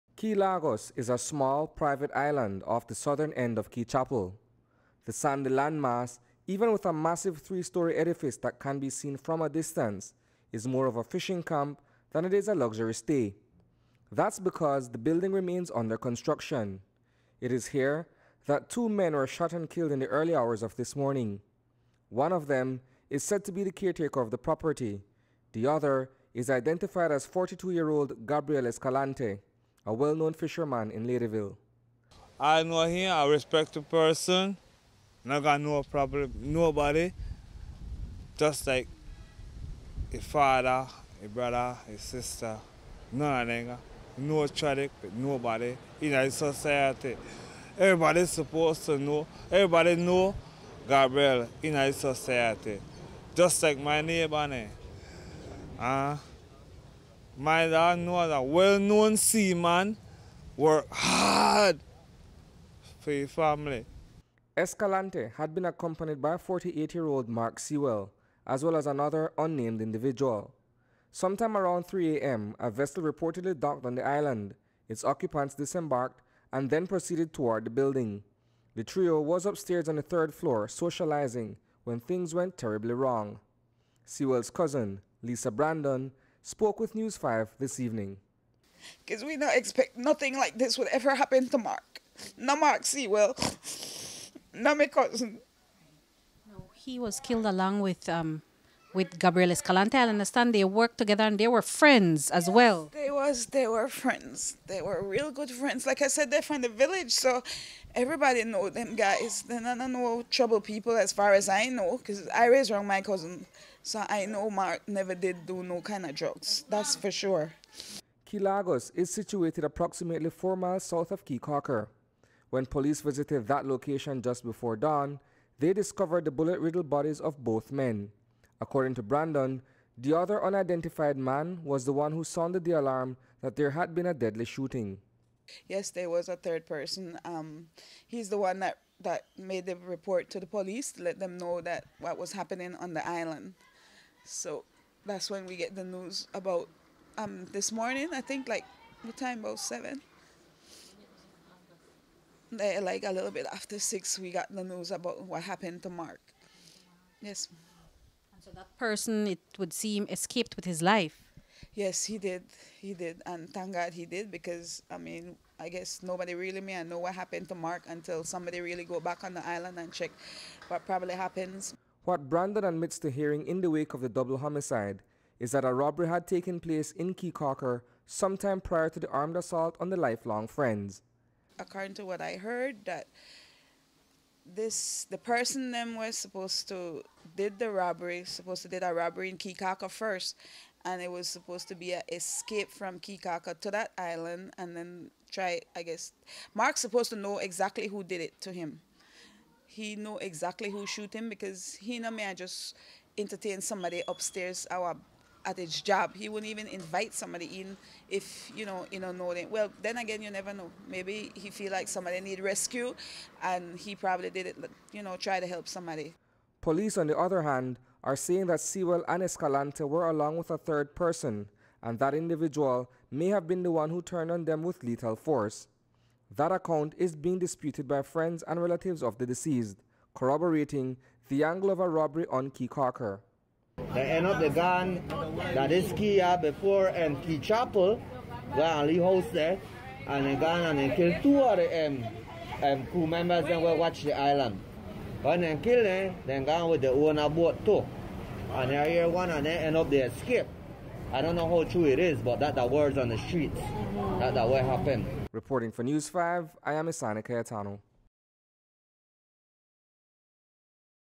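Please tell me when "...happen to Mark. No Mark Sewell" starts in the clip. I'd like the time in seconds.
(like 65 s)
91 s.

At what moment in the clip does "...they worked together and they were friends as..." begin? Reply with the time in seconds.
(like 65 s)
100 s.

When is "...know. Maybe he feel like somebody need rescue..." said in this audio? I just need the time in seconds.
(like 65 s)
210 s.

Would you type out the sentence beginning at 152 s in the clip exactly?
Eh, like a little bit after six, we got the news about what happened to Mark.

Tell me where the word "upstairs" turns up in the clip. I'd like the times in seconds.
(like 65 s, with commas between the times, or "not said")
79 s, 204 s.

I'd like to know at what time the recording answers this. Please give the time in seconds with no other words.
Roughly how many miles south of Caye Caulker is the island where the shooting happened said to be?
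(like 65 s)
120 s.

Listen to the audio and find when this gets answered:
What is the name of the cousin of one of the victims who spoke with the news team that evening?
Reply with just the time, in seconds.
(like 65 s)
85 s.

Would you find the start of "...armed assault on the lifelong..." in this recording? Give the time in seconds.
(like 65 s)
179 s.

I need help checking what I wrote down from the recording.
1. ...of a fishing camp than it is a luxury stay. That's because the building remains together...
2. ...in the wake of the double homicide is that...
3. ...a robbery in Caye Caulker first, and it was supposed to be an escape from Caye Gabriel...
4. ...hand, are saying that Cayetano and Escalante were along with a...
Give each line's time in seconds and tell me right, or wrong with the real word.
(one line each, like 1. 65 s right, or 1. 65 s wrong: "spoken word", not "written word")
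1. 10 s wrong: "under", not "together"
2. 173 s right
3. 188 s wrong: "Caulker", not "Gabriel"
4. 217 s wrong: "Sewell", not "Cayetano".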